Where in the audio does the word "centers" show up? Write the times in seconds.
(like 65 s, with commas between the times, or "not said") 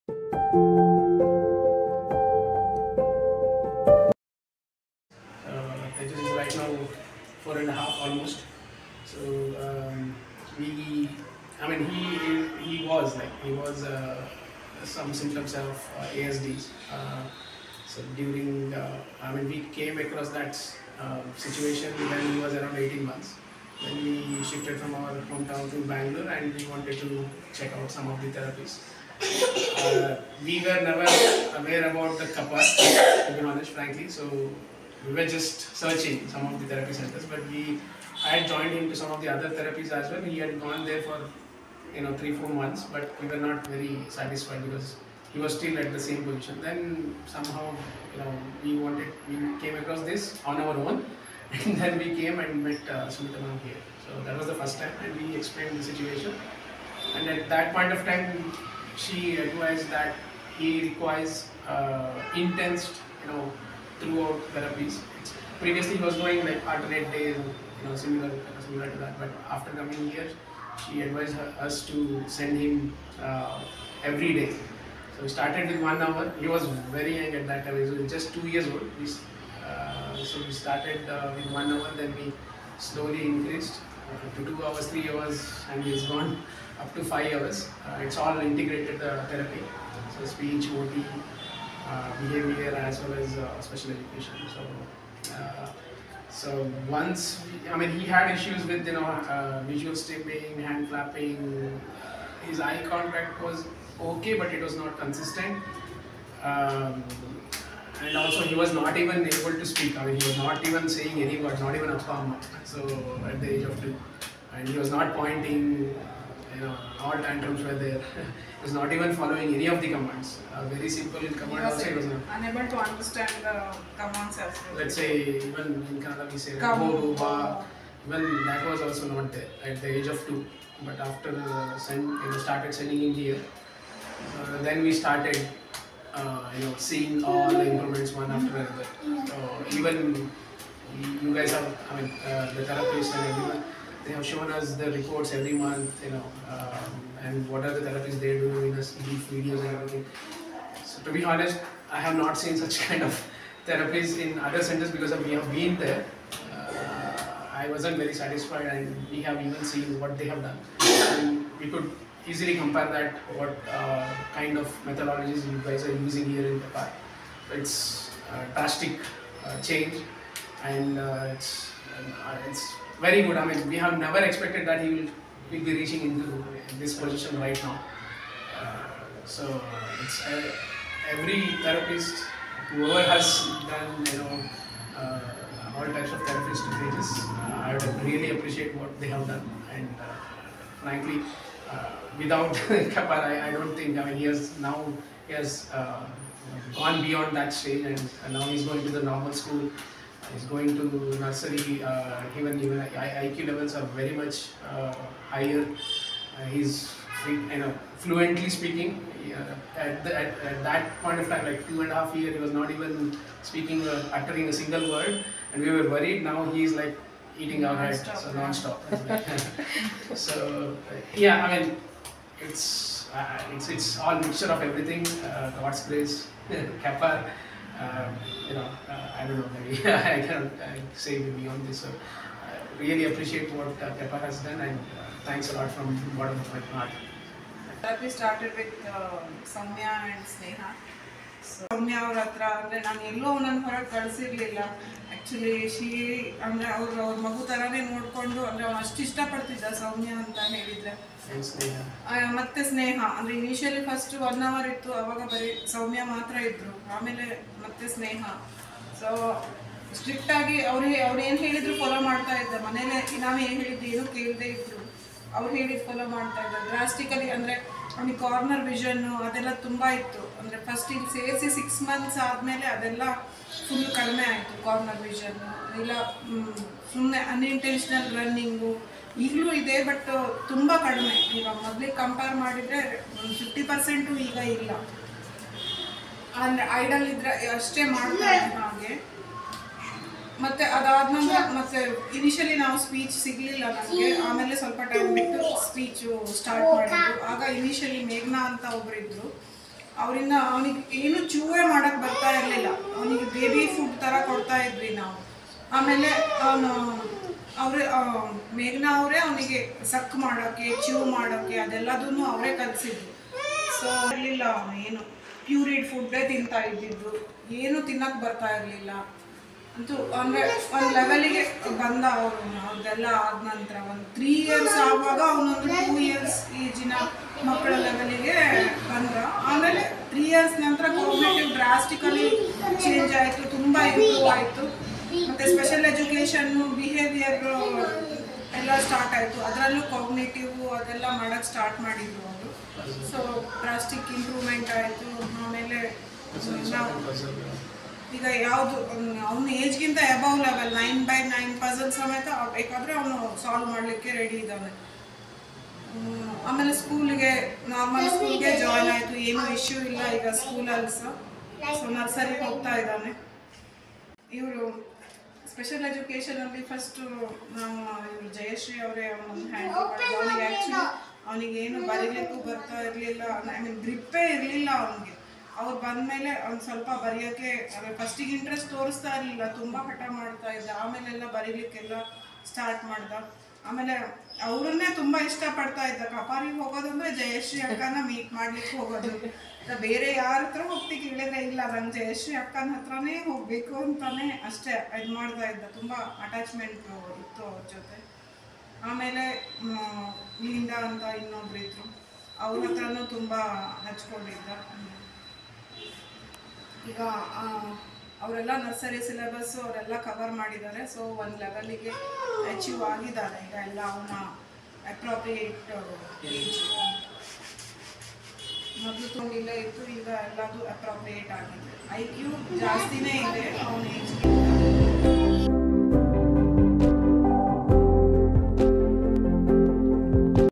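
36 s, 154 s.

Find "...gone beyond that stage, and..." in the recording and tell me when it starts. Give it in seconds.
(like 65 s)
196 s.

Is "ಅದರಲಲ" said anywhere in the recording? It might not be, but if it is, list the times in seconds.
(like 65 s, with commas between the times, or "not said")
339 s.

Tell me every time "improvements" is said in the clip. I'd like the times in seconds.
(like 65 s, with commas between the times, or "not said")
137 s.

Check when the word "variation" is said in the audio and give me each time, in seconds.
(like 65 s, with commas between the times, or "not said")
not said.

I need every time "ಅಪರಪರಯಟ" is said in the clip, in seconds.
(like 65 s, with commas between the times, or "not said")
414 s, 420 s.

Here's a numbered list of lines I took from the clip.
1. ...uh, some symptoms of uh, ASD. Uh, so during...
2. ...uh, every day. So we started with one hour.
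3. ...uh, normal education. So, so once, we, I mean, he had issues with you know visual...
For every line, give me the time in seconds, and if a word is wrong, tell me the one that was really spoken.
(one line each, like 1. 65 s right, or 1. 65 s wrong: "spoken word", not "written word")
1. 13 s right
2. 73 s right
3. 93 s wrong: "special", not "normal".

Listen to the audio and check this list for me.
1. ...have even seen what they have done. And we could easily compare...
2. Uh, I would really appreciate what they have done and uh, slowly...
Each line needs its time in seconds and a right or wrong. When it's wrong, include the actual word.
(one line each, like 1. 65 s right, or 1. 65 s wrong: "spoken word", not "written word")
1. 159 s right
2. 187 s wrong: "frankly", not "slowly".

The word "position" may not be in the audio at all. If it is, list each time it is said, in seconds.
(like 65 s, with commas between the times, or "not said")
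46 s, 176 s.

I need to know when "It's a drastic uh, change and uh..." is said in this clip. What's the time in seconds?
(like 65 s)
167 s.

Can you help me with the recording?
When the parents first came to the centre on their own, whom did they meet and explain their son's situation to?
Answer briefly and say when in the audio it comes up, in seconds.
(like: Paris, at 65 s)
Sumitha, at 53 s.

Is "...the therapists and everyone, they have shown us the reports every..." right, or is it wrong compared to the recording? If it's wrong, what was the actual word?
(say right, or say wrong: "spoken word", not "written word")
right.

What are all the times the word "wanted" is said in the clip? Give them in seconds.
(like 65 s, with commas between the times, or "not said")
26 s, 48 s.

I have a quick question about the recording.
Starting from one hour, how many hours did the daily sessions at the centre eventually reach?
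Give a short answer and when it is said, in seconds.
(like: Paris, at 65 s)
5 hours, at 87 s.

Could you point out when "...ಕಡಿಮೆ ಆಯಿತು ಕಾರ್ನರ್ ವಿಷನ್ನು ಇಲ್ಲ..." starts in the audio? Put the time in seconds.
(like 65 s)
273 s.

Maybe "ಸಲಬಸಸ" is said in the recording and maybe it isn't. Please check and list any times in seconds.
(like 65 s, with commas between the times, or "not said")
409 s.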